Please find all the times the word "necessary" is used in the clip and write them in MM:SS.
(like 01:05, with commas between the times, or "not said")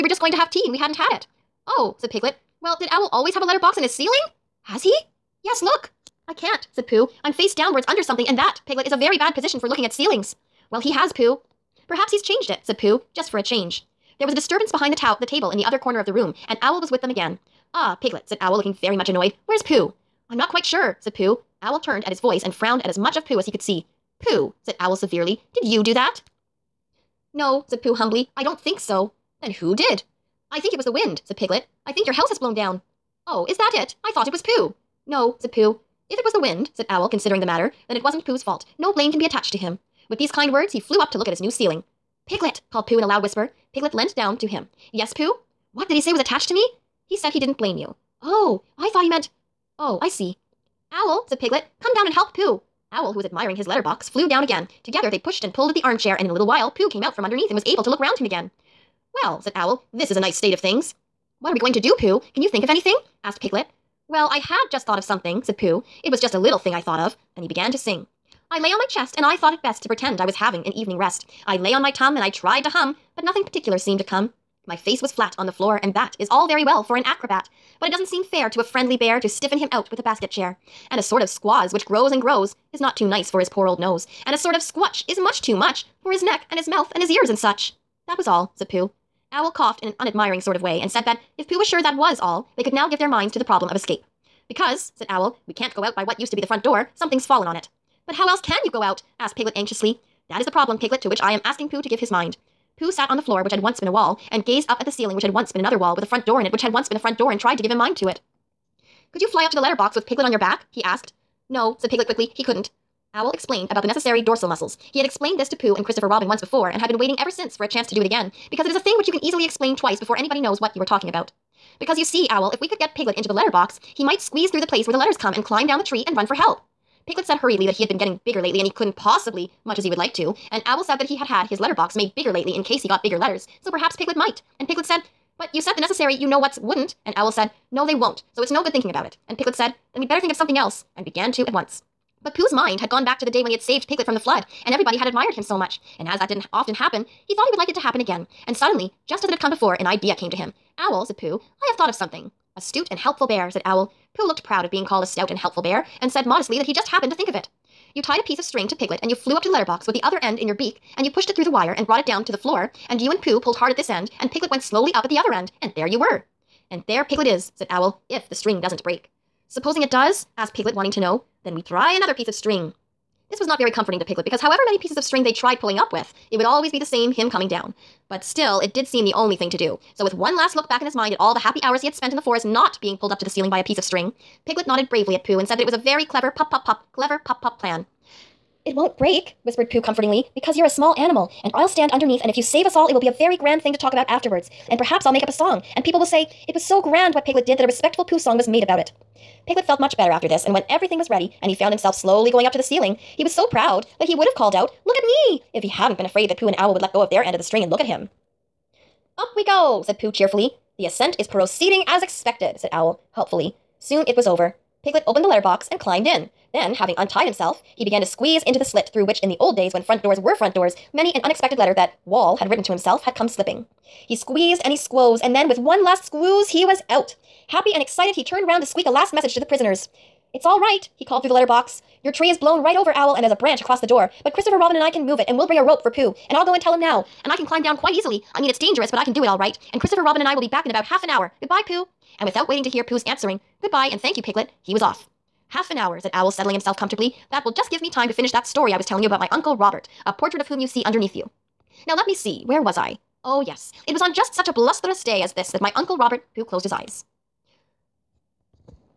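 01:53, 02:15.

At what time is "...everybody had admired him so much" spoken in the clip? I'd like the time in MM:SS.
02:24.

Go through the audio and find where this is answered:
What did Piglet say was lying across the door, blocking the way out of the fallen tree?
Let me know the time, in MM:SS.
03:53.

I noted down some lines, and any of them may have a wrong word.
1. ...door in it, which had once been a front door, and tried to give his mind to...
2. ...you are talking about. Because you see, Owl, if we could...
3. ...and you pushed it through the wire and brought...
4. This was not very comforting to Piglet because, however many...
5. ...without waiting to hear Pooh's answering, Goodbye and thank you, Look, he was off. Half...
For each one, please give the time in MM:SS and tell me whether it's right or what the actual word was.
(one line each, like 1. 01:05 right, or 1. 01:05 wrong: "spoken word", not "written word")
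1. 01:46 right
2. 02:00 right
3. 02:40 right
4. 02:53 right
5. 04:02 wrong: "Piglet", not "Look".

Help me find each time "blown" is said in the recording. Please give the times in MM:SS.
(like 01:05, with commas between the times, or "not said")
00:32, 03:52.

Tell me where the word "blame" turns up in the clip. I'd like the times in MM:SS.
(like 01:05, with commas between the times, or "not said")
00:38, 00:47.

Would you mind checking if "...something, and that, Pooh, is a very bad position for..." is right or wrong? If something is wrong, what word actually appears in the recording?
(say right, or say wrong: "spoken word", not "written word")
wrong: "Piglet", not "Pooh".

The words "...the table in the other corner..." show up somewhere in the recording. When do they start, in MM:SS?
00:15.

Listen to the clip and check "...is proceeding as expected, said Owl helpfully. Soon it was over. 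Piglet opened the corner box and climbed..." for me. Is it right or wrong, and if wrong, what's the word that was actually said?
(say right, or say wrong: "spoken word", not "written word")
wrong: "letter", not "corner".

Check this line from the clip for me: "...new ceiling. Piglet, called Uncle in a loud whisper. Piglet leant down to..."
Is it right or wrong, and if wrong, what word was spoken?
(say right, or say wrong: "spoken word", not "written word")
wrong: "Pooh", not "Uncle".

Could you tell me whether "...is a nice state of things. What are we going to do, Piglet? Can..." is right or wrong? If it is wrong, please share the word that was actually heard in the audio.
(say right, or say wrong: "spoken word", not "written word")
wrong: "Pooh", not "Piglet".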